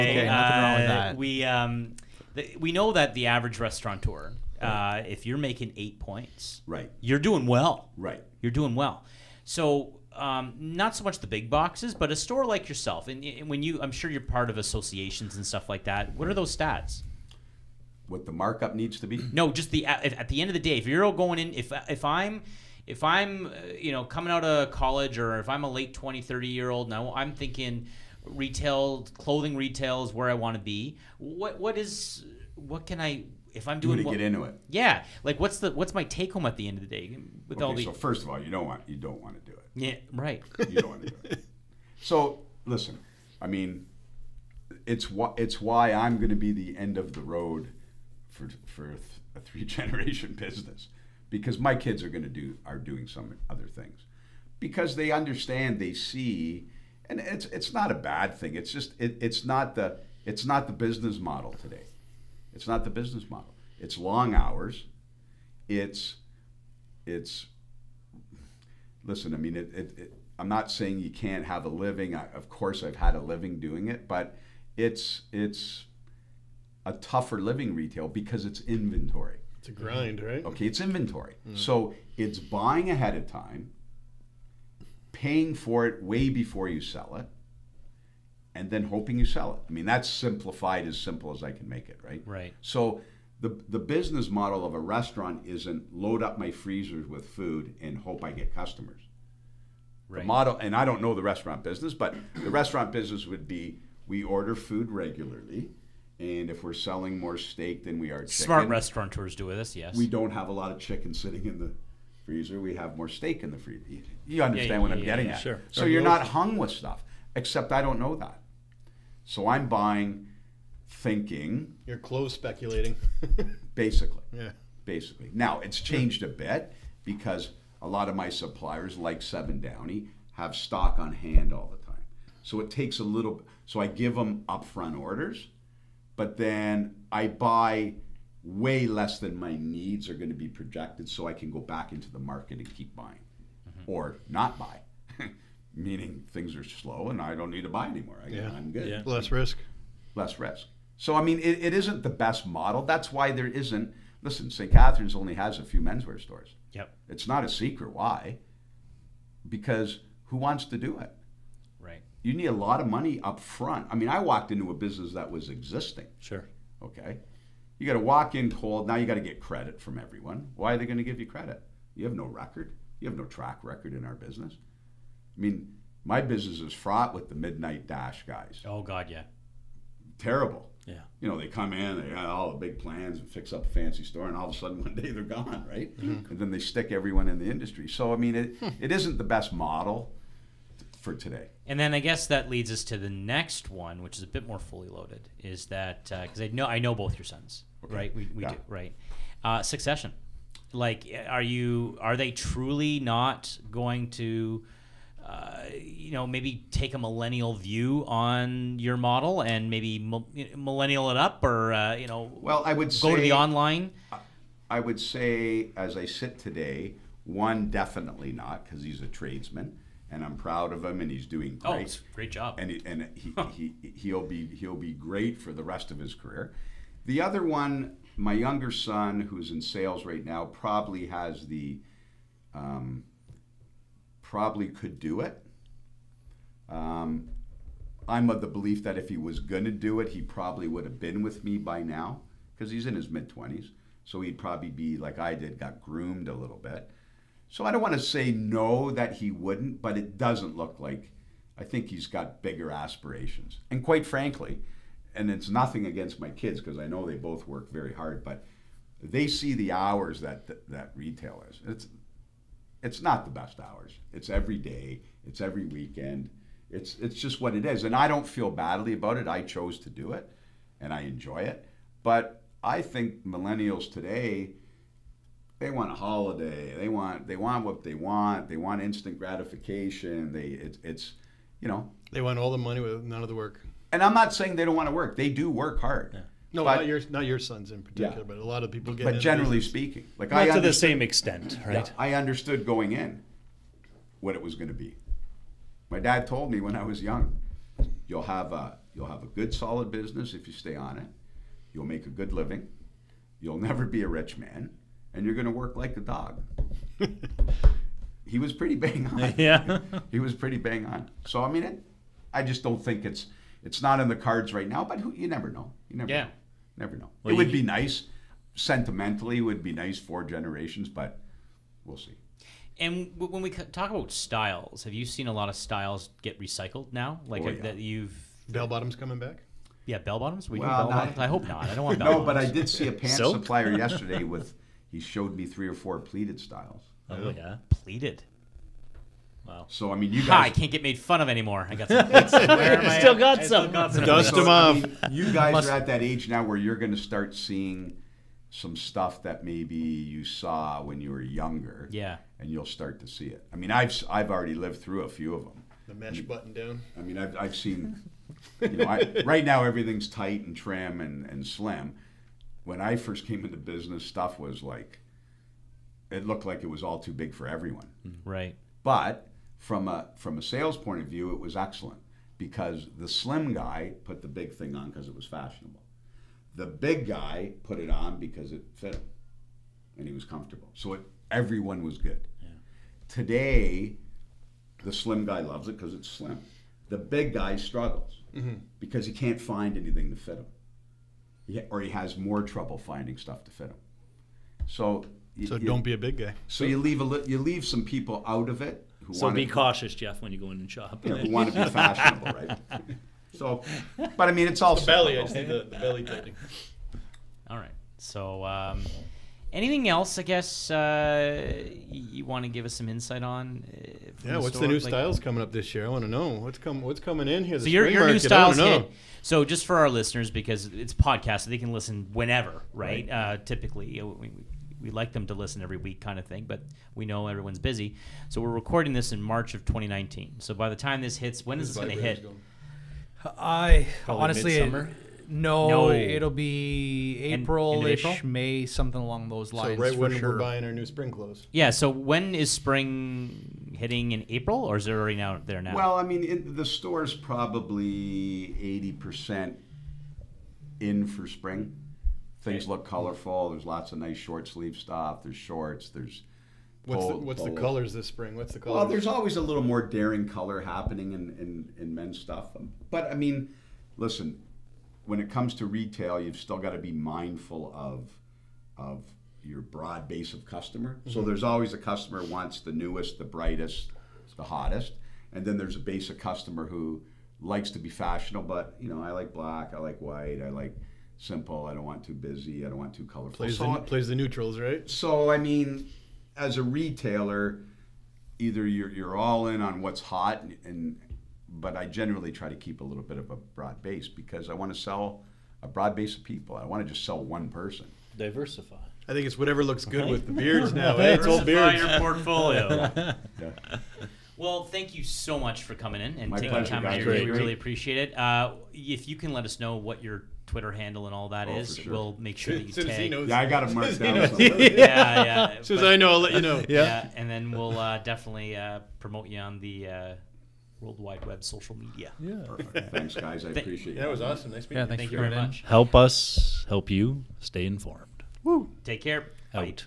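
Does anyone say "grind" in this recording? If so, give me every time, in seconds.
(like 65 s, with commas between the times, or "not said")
79 s.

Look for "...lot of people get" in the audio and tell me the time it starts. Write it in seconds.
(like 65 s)
288 s.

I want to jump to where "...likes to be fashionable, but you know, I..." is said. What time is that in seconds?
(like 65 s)
477 s.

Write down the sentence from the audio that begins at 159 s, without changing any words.
Because who wants to do it?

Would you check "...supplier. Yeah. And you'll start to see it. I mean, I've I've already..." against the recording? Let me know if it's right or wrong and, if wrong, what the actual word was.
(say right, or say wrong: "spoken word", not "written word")
wrong: "younger", not "supplier".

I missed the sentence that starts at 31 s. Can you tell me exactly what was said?
What what is what can I if I'm doing to what, get into it?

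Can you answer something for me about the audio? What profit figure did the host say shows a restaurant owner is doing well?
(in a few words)
8 points.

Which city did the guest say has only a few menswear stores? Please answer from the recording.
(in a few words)
St. Catharines.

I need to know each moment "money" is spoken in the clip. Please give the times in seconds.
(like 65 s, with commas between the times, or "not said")
162 s, 282 s.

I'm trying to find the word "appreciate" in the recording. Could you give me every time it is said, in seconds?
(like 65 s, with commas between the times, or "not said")
507 s, 523 s.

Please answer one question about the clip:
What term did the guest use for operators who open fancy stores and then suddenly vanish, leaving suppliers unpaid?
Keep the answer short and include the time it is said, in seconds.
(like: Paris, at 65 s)
midnight dash guys, at 177 s.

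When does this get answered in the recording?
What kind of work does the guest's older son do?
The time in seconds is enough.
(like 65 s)
219 s.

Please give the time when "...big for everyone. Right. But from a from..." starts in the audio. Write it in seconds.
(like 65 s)
367 s.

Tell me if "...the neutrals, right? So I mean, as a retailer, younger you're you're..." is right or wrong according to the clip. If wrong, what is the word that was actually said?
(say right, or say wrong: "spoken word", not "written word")
wrong: "either", not "younger".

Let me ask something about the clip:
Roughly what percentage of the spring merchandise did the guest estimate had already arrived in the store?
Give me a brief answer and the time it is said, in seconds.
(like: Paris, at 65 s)
80%, at 448 s.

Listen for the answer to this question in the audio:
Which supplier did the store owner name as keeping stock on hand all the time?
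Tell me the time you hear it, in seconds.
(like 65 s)
129 s.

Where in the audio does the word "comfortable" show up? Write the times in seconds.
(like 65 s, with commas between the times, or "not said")
380 s.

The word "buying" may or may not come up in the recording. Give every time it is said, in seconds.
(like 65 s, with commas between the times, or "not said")
82 s, 119 s, 142 s, 440 s.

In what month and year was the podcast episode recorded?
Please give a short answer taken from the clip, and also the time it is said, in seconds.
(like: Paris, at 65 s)
March 2019, at 429 s.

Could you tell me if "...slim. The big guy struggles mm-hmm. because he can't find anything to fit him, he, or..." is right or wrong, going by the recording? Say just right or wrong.
right.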